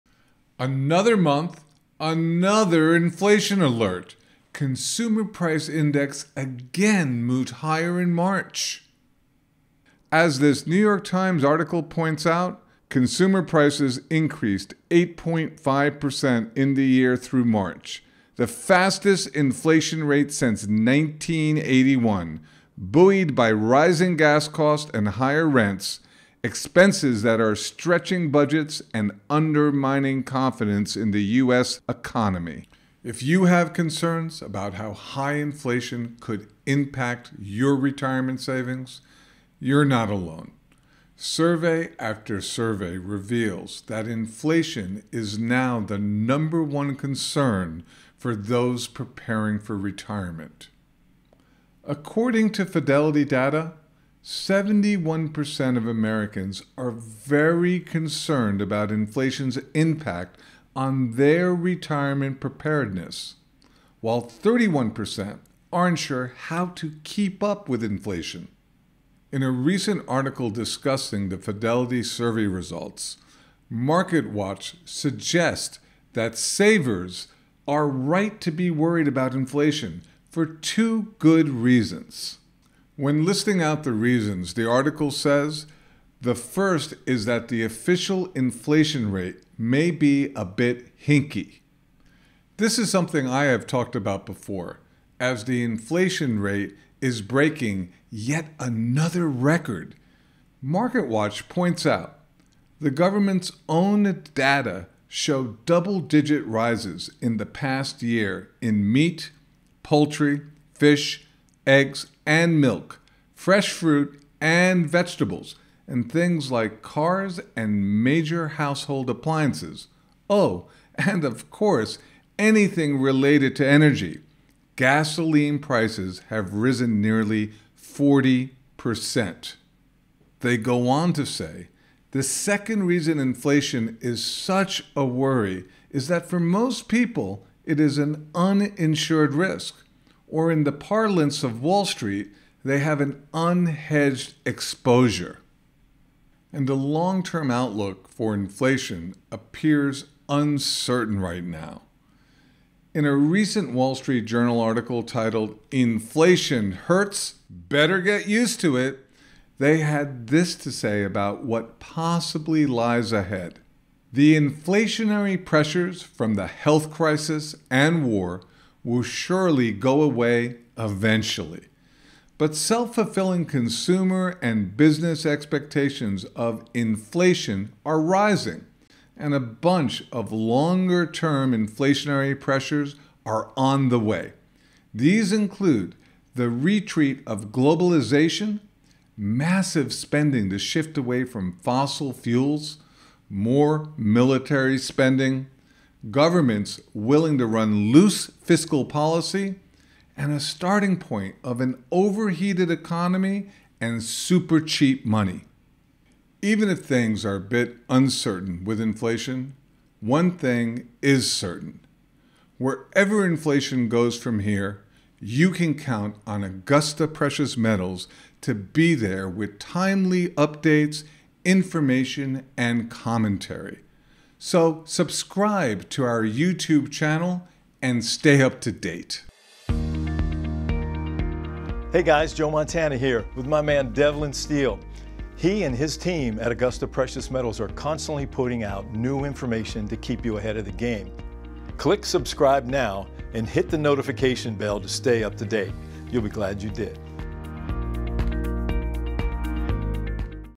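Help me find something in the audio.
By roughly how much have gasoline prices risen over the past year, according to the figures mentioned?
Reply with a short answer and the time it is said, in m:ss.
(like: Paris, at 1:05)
nearly 40%, at 2:07.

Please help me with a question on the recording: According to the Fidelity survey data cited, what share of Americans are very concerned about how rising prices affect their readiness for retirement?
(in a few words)
71%.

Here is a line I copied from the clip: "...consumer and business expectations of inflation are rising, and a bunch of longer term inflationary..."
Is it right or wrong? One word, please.
right.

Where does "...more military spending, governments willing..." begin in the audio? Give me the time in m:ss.
3:13.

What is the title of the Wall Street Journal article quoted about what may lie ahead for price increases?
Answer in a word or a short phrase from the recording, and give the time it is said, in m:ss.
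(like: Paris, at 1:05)
Inflation Hurts, Better Get Used to It, at 2:35.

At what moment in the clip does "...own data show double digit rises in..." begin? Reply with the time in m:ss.
1:43.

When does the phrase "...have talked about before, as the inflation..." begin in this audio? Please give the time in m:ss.
1:33.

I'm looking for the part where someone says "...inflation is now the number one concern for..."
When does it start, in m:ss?
0:44.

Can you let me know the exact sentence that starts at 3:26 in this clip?
Even if things are a bit uncertain with inflation, one thing is certain.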